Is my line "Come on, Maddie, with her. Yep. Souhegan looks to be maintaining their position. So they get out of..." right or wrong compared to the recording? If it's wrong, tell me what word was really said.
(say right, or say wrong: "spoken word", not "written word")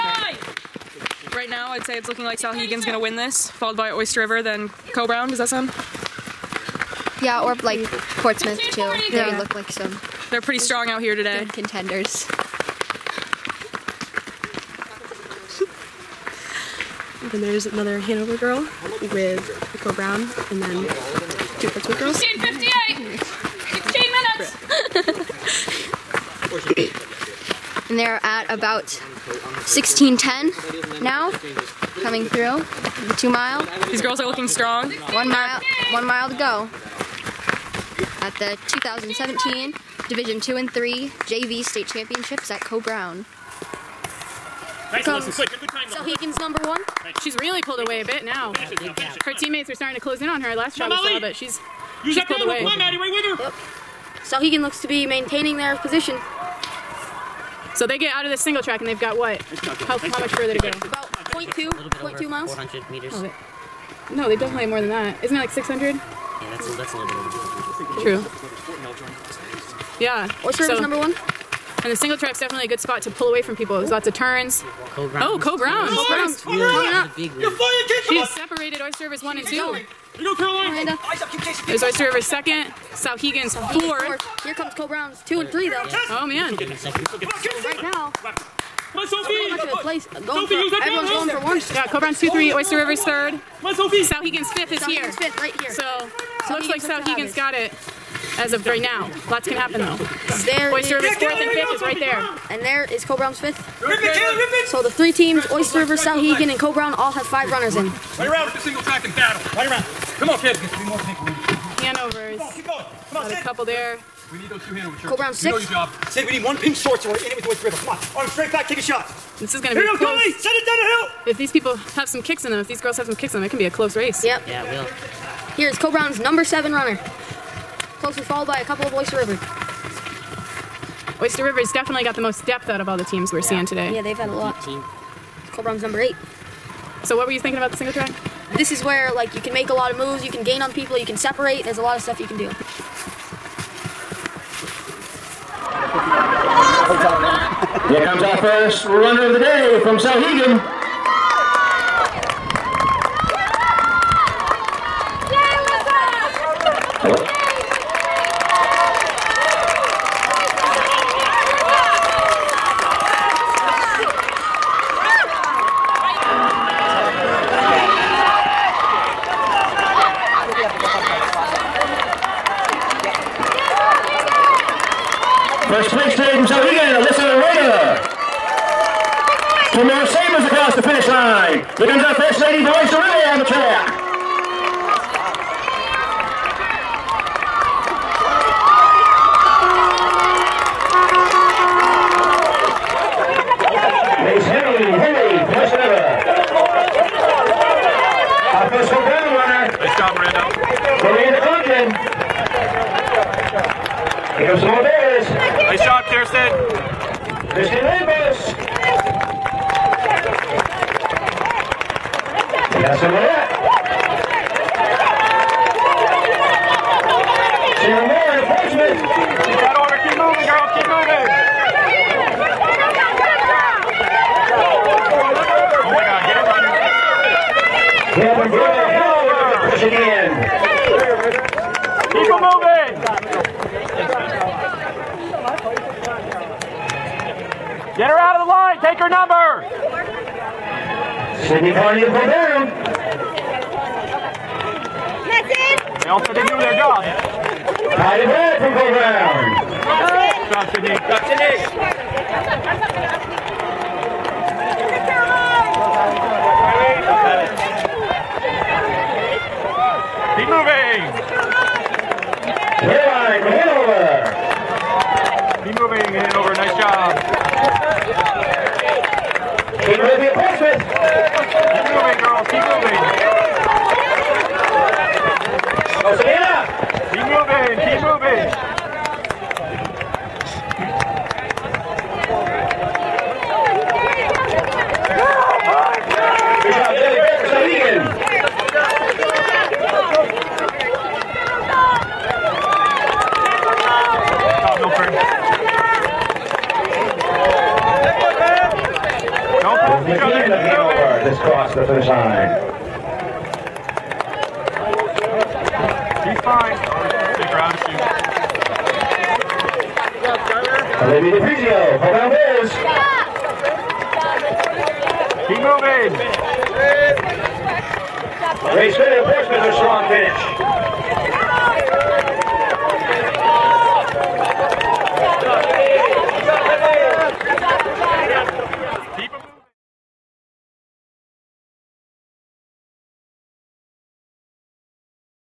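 right.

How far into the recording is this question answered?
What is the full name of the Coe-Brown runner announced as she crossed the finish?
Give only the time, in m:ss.
4:01.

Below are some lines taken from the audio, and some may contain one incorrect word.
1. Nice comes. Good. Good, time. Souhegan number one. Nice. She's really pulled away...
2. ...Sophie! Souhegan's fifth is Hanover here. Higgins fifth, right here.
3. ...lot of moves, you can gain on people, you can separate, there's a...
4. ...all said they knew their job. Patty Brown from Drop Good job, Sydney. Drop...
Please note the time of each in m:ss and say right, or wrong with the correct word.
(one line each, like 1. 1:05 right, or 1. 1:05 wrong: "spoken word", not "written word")
1. 0:44 right
2. 1:33 wrong: "South", not "Hanover"
3. 2:19 right
4. 4:06 wrong: "Bird", not "Brown".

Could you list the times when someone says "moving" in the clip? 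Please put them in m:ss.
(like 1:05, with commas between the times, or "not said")
4:25, 5:15.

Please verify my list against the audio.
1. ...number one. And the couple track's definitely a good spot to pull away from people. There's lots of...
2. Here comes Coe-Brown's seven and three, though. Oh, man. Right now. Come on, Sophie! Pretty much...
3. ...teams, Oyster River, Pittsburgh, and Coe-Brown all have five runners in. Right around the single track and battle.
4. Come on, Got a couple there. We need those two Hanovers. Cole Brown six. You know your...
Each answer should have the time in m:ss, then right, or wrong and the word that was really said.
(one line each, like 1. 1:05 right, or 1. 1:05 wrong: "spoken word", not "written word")
1. 1:10 wrong: "single", not "couple"
2. 1:24 wrong: "two", not "seven"
3. 1:45 wrong: "Souhegan", not "Pittsburgh"
4. 1:53 right.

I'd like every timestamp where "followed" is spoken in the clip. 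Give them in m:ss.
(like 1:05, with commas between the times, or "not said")
0:03, 2:08.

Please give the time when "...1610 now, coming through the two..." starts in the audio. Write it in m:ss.
0:29.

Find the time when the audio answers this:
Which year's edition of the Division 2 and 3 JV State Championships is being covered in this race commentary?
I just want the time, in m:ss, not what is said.
0:38.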